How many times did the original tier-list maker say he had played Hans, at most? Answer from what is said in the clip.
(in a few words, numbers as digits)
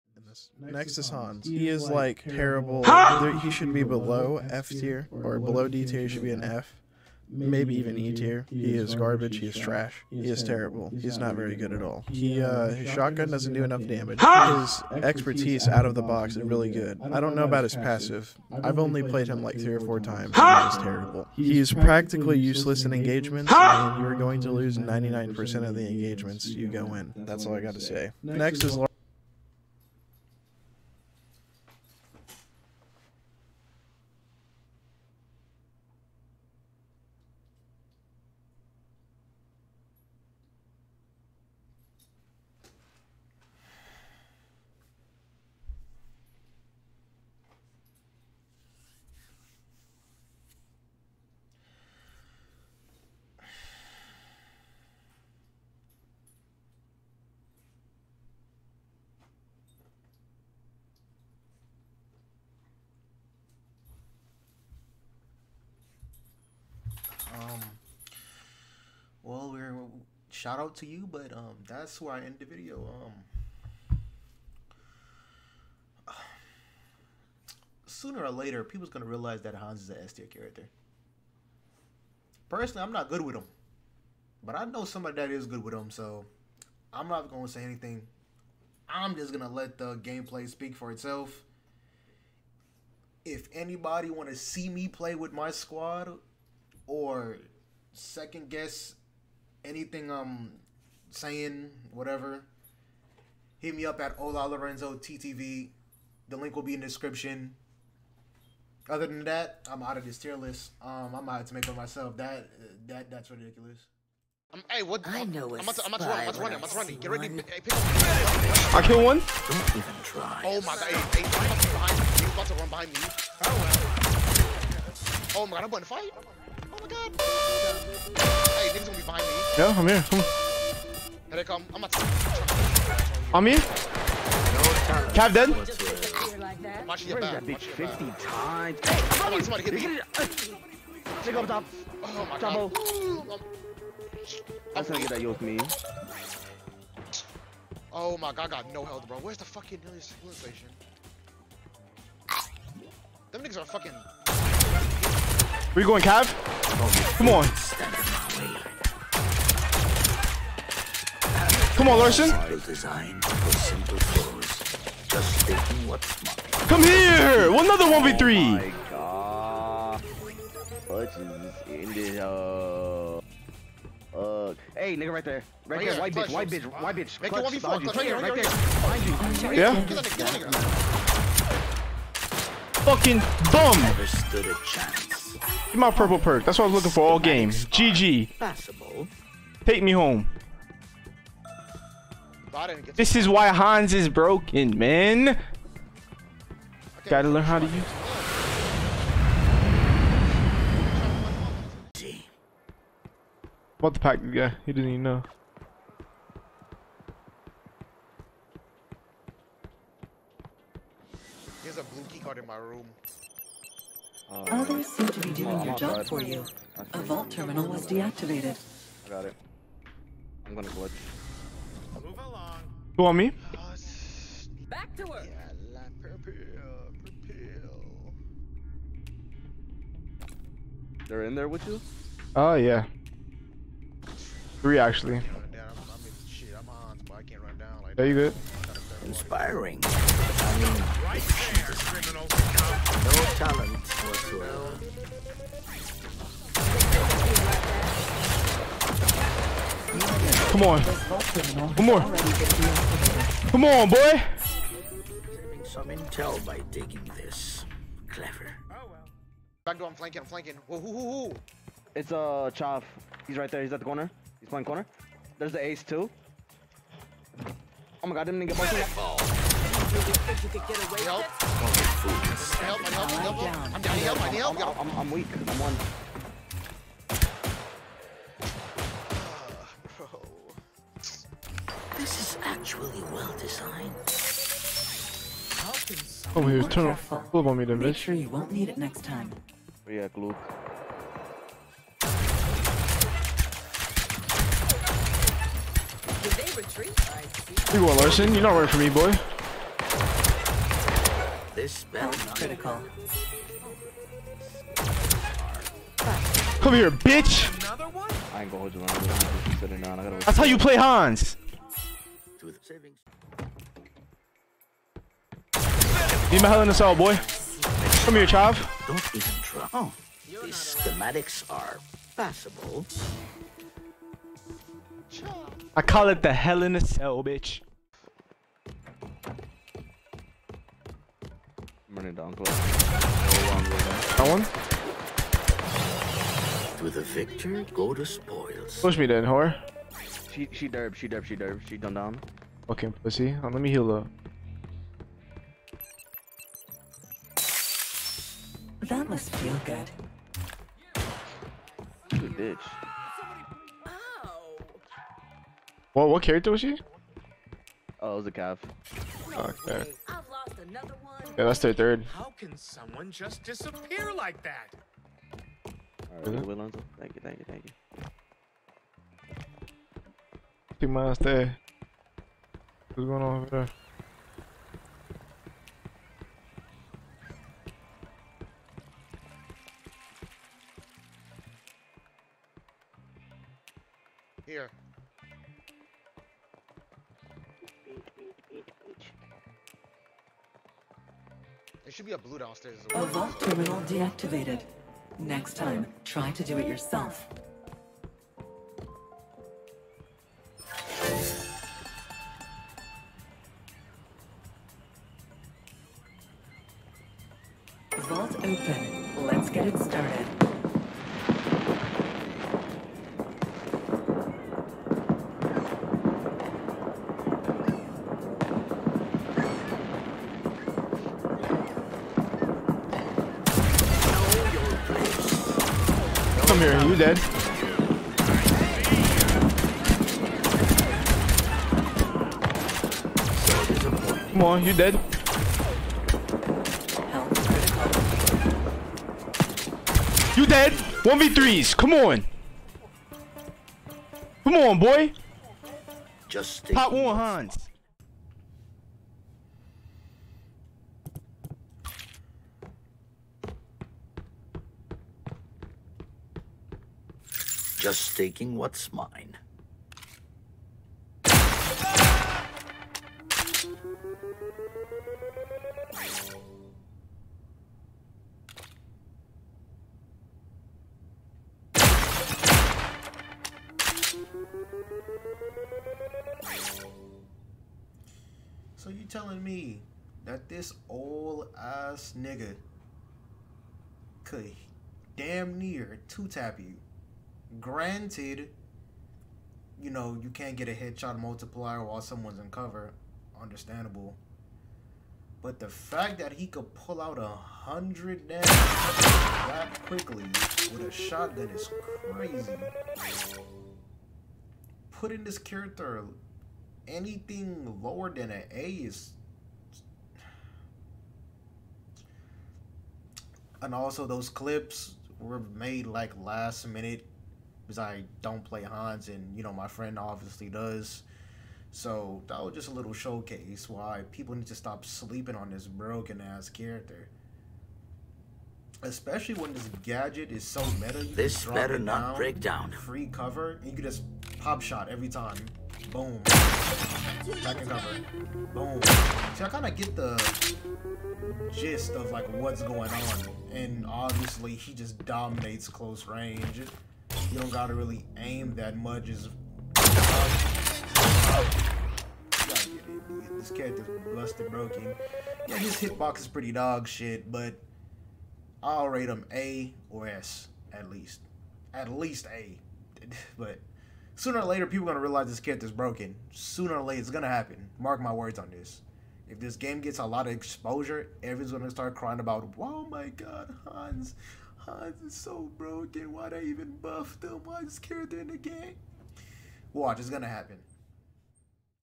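4.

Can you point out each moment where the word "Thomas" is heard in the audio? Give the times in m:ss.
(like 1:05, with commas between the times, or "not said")
not said.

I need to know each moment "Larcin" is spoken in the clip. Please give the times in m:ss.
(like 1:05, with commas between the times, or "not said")
2:41, 4:57.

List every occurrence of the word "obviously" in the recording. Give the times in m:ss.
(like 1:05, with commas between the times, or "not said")
8:39, 9:03.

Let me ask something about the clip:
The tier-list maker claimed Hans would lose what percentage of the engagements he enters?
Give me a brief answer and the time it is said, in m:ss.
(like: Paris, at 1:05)
99%, at 0:24.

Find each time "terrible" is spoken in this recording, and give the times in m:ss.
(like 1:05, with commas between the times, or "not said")
0:02, 0:10, 0:20.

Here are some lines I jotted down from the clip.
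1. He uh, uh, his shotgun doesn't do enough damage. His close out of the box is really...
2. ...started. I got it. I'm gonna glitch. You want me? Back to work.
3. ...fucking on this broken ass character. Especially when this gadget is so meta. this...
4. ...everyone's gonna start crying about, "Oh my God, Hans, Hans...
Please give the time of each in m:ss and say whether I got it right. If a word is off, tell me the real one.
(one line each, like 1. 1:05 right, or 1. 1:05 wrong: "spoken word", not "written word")
1. 0:12 wrong: "expertise", not "close"
2. 3:37 wrong: "deactivated", not "started"
3. 8:44 wrong: "sleeping", not "fucking"
4. 9:31 right.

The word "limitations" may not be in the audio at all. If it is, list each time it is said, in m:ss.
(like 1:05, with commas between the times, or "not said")
not said.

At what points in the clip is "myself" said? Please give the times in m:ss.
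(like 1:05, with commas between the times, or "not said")
1:51.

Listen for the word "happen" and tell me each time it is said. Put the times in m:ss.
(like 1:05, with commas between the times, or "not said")
9:27, 9:40.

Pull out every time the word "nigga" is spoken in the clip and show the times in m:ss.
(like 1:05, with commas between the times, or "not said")
2:33, 2:54, 8:02.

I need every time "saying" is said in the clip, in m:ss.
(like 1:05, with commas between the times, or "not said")
1:41.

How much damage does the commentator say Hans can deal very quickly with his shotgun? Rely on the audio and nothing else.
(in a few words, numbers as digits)
100.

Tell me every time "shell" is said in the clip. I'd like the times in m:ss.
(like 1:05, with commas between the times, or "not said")
not said.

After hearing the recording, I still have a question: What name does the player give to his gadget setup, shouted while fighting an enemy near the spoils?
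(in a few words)
Hell in a cell.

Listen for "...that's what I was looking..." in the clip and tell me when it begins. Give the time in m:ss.
3:06.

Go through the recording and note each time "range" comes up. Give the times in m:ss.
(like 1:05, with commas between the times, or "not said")
9:06.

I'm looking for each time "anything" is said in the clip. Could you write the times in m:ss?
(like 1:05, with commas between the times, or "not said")
1:27, 1:39, 8:26.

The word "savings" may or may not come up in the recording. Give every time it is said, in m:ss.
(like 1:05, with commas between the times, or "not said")
5:12.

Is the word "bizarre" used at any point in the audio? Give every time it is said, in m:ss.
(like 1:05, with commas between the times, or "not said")
not said.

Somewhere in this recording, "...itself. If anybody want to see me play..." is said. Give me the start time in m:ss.
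1:30.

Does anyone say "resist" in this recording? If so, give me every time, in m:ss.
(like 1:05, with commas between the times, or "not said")
not said.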